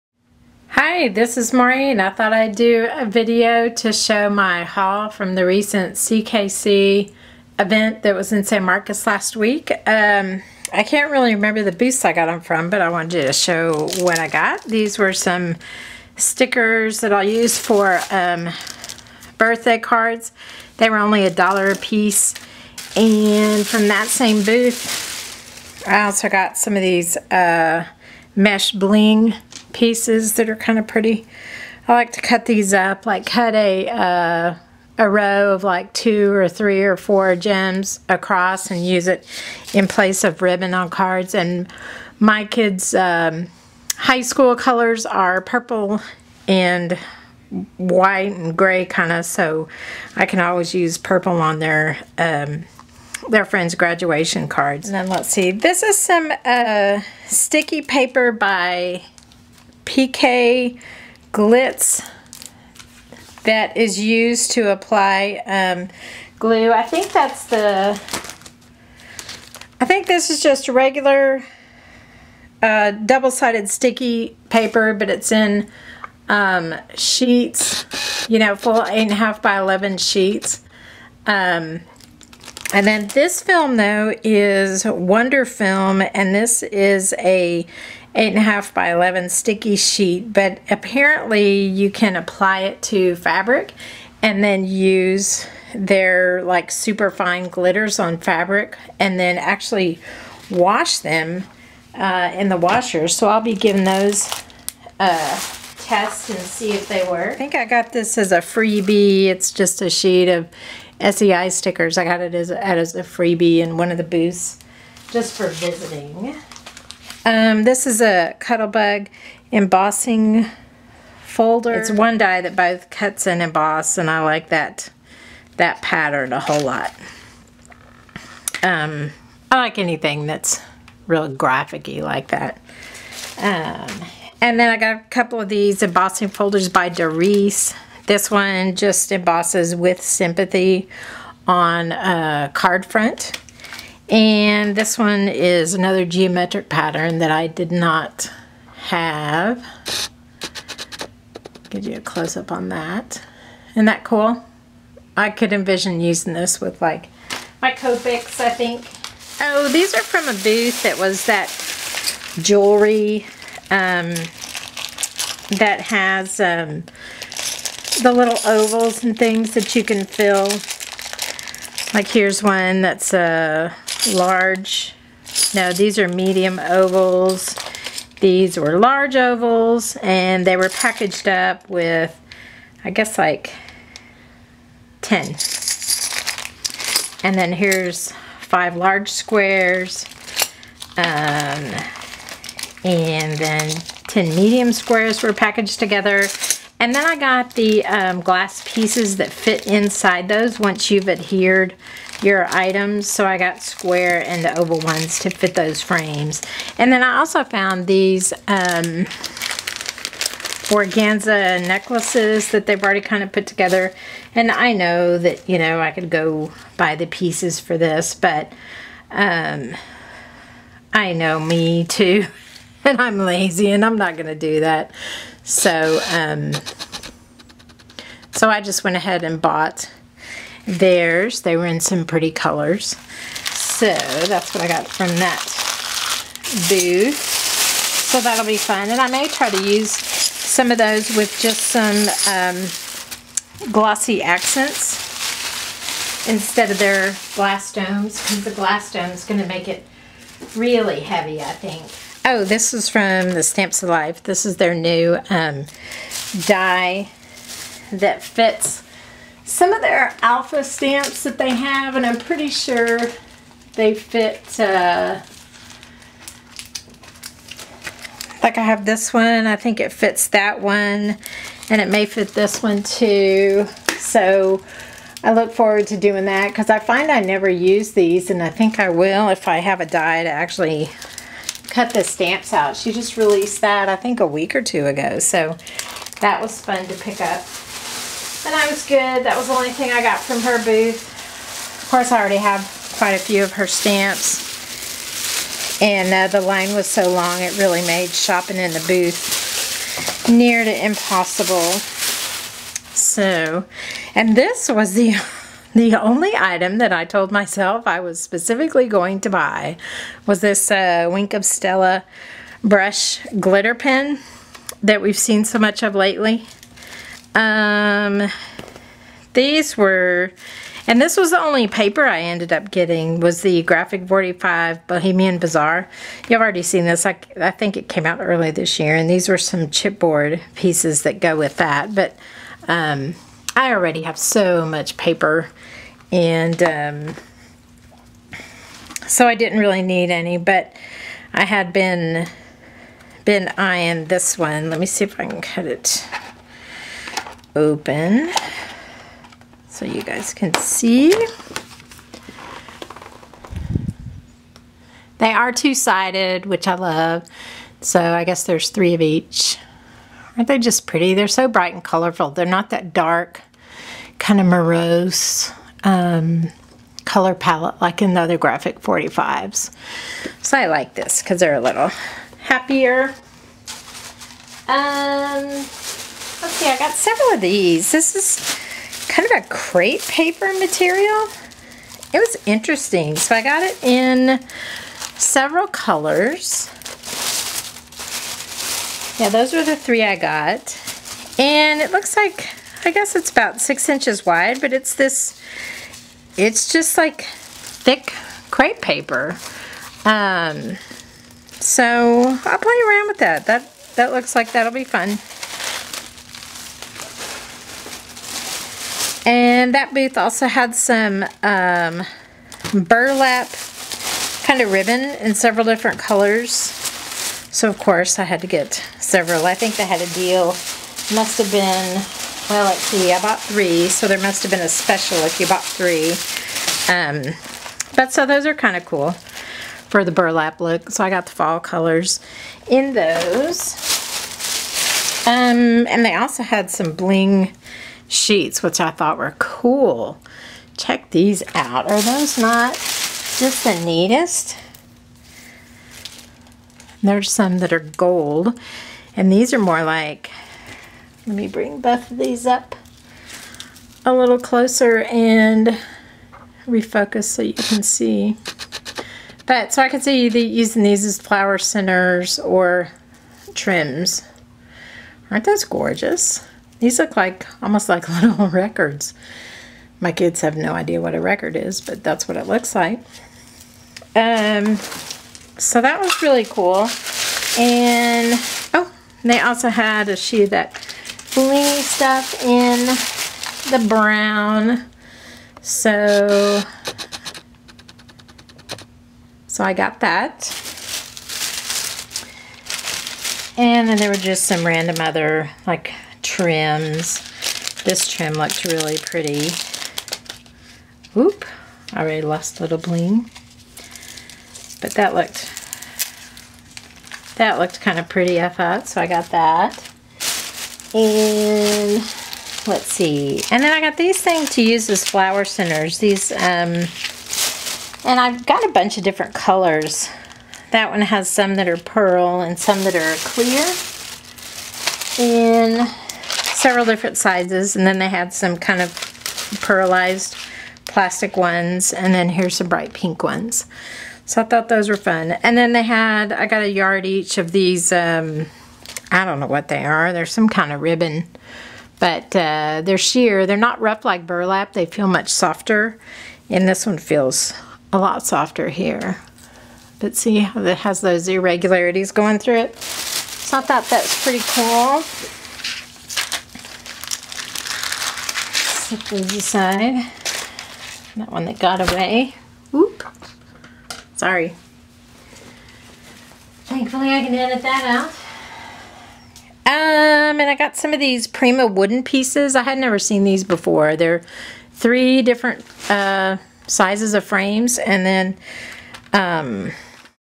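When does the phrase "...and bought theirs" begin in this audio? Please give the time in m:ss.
3:49.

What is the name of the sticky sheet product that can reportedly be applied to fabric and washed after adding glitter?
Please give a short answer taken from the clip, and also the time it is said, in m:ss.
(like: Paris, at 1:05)
Wonder Film, at 1:24.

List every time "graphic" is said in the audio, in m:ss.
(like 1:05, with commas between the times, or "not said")
2:11, 5:23, 6:08.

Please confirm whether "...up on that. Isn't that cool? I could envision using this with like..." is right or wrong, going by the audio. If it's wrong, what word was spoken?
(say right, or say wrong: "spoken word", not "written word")
right.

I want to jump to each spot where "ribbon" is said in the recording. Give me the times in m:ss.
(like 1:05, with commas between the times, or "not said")
0:40, 6:54, 9:00.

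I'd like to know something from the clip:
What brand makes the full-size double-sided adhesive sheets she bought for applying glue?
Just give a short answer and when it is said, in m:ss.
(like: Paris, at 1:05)
PK Glitz, at 0:59.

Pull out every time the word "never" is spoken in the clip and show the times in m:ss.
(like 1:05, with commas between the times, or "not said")
4:37, 9:32.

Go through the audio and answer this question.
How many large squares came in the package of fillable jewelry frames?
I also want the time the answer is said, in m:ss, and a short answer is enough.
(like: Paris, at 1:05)
5, at 3:08.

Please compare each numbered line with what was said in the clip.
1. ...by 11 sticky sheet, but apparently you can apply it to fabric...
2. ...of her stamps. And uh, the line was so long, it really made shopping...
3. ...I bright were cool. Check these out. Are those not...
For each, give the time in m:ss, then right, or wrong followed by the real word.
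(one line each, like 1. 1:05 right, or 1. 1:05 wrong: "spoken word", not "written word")
1. 1:28 right
2. 4:53 right
3. 7:18 wrong: "thought", not "bright".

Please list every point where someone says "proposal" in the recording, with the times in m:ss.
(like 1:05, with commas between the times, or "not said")
not said.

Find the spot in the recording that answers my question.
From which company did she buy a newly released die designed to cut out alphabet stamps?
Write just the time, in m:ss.
4:13.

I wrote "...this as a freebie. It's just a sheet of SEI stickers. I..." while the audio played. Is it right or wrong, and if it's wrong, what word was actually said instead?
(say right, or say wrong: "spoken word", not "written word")
right.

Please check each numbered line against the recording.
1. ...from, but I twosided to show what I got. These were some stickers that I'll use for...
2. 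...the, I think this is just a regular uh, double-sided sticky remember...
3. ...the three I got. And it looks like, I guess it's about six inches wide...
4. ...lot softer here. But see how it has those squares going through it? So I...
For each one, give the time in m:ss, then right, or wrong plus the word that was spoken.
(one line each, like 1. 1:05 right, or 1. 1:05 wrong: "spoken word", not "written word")
1. 0:12 wrong: "wanted", not "twosided"
2. 1:07 wrong: "paper", not "remember"
3. 6:29 right
4. 9:07 wrong: "irregularities", not "squares".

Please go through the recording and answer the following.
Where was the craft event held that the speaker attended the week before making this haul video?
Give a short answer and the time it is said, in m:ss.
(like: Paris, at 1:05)
San Marcos, at 0:08.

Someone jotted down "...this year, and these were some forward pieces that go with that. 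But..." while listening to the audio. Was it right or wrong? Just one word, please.
wrong.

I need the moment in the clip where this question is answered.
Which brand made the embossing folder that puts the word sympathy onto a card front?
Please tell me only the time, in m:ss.
2:16.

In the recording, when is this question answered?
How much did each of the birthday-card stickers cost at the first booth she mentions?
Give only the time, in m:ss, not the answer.
0:21.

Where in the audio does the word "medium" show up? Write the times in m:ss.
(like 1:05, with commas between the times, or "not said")
2:56, 3:14.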